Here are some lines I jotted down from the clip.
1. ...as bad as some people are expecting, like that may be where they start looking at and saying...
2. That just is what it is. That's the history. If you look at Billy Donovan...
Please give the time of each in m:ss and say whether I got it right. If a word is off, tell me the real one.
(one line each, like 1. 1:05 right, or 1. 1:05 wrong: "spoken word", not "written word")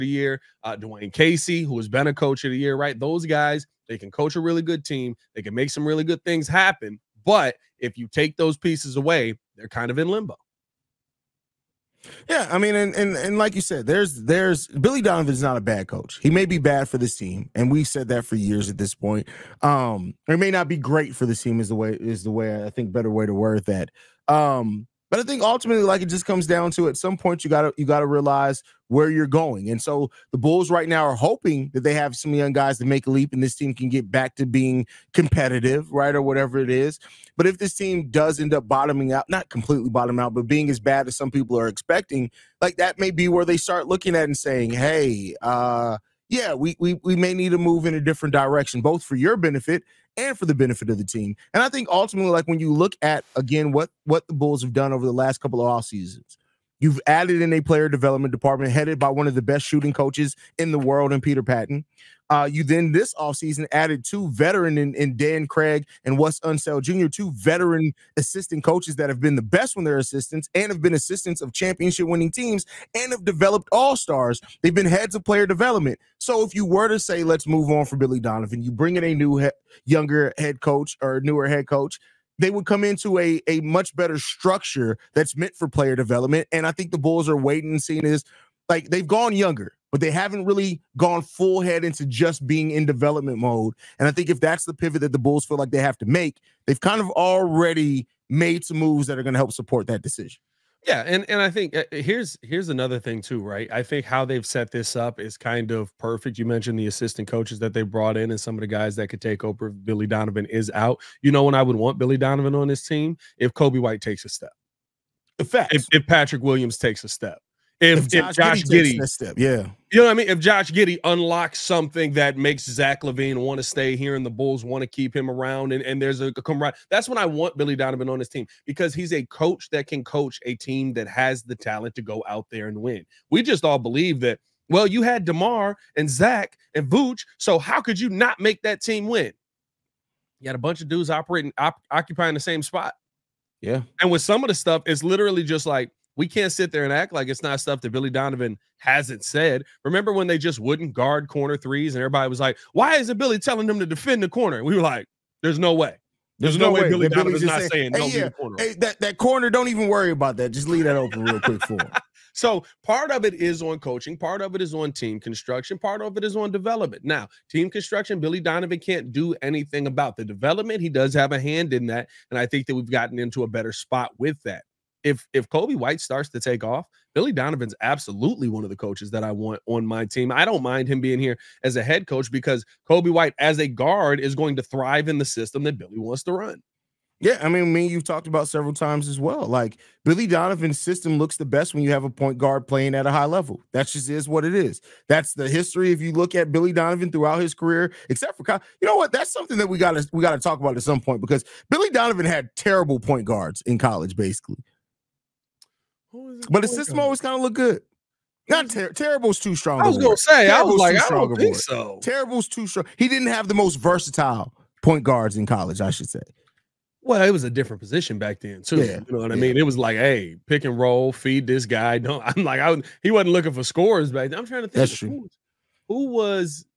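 1. 0:40 right
2. 3:13 right.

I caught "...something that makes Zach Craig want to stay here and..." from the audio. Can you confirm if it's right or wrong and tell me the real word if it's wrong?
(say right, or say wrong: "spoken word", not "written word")
wrong: "LaVine", not "Craig".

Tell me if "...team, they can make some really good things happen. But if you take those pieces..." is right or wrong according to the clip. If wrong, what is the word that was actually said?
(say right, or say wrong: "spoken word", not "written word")
right.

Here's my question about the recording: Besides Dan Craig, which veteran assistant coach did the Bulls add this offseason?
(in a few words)
Wes Unseld Jr.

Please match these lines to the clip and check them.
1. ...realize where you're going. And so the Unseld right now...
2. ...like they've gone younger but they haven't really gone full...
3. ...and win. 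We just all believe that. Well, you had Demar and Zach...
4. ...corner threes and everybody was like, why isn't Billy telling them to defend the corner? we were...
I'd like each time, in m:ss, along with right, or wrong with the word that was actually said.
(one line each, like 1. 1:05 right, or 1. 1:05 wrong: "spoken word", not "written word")
1. 0:28 wrong: "Bulls", not "Unseld"
2. 1:28 right
3. 2:12 right
4. 2:31 right.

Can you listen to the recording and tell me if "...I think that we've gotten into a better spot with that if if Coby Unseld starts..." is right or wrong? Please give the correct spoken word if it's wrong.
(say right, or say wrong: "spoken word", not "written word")
wrong: "White", not "Unseld".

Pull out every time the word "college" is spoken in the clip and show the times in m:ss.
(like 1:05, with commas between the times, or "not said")
3:23, 3:35.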